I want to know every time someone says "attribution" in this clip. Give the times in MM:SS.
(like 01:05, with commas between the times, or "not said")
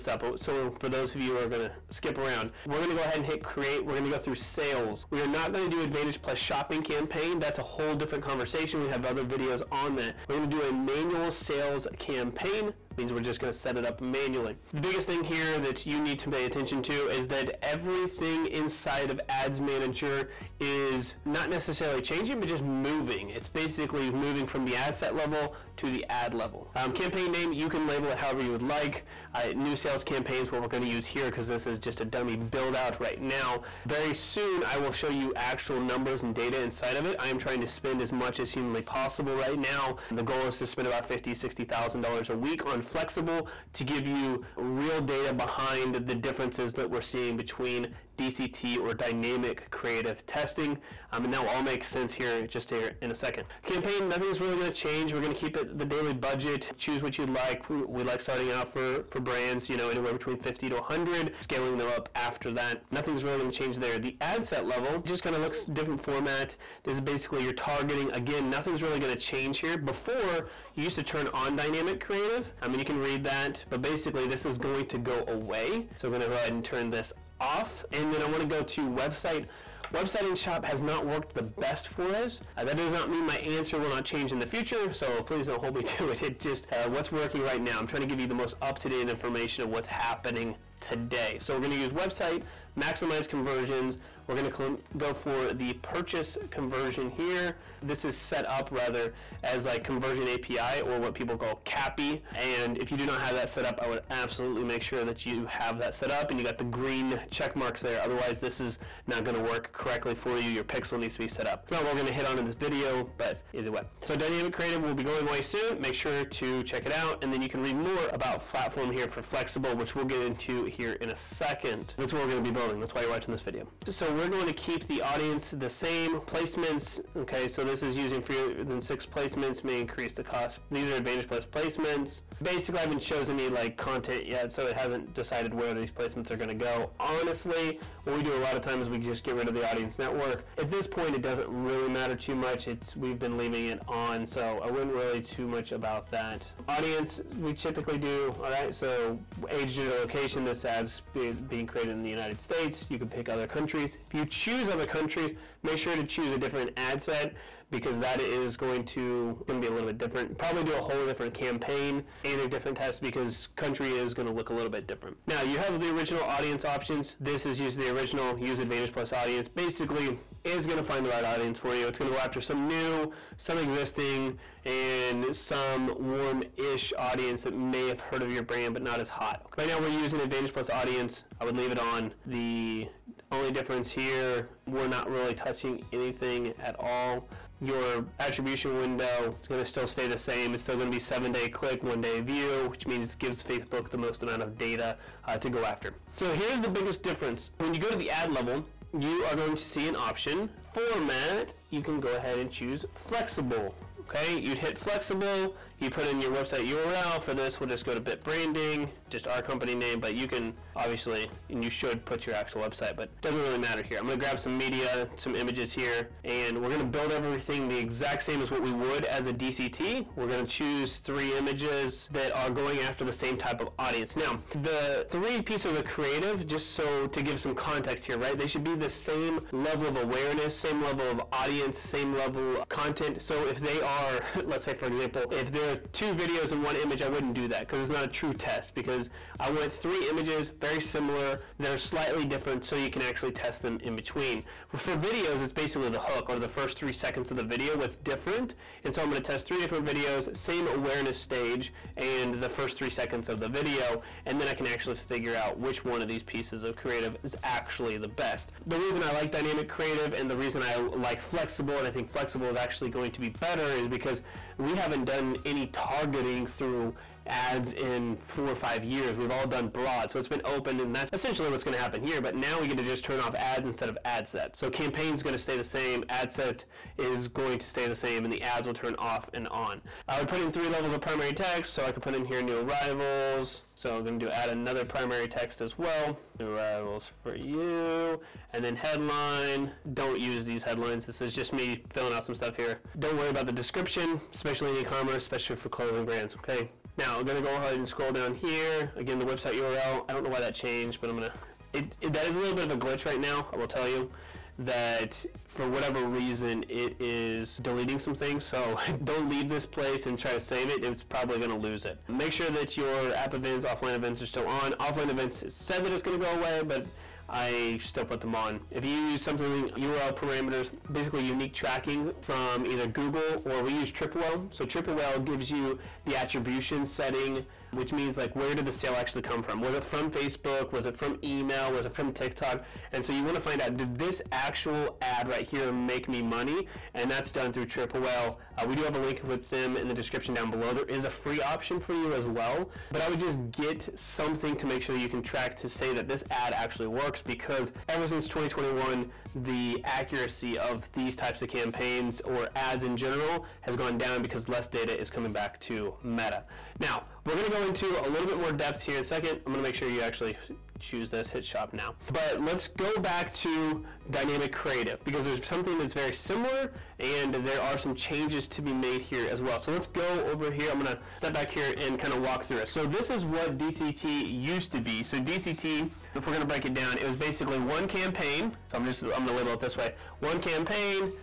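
03:08, 05:26.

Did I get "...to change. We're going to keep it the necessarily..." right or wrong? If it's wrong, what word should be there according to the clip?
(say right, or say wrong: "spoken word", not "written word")
wrong: "daily", not "necessarily".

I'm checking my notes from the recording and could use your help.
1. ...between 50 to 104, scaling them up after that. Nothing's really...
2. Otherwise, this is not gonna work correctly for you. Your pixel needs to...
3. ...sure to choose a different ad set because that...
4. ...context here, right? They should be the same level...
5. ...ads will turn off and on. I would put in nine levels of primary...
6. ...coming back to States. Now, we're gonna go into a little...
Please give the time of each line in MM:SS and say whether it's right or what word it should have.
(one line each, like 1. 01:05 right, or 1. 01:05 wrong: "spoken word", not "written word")
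1. 01:00 wrong: "100", not "104"
2. 01:47 right
3. 02:35 right
4. 03:47 right
5. 04:38 wrong: "three", not "nine"
6. 05:55 wrong: "Meta", not "States".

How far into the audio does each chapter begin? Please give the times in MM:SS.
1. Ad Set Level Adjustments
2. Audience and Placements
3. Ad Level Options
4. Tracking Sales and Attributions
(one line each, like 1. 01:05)
1. 01:06
2. 02:10
3. 03:21
4. 05:14.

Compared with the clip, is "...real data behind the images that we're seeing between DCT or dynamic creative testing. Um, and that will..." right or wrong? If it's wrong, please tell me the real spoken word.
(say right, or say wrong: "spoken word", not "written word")
wrong: "differences", not "images".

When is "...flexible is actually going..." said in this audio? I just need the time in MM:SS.
04:22.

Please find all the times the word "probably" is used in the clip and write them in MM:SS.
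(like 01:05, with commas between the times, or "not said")
02:40, 05:11.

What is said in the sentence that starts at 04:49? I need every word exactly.
Don't use these headlines, this is just me filling out some stuff here.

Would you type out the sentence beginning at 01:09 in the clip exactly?
Before, you used to turn on dynamic creative.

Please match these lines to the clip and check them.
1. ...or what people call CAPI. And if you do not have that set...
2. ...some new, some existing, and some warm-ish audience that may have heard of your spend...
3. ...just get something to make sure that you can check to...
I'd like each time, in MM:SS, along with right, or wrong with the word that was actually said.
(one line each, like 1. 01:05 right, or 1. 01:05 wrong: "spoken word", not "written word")
1. 01:40 right
2. 02:52 wrong: "brand", not "spend"
3. 05:43 wrong: "track", not "check".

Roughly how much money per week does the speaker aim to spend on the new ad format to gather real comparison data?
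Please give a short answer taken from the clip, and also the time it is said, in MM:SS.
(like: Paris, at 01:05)
$50,000-60,000, at 00:41.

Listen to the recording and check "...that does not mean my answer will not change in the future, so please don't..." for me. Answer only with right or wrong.
right.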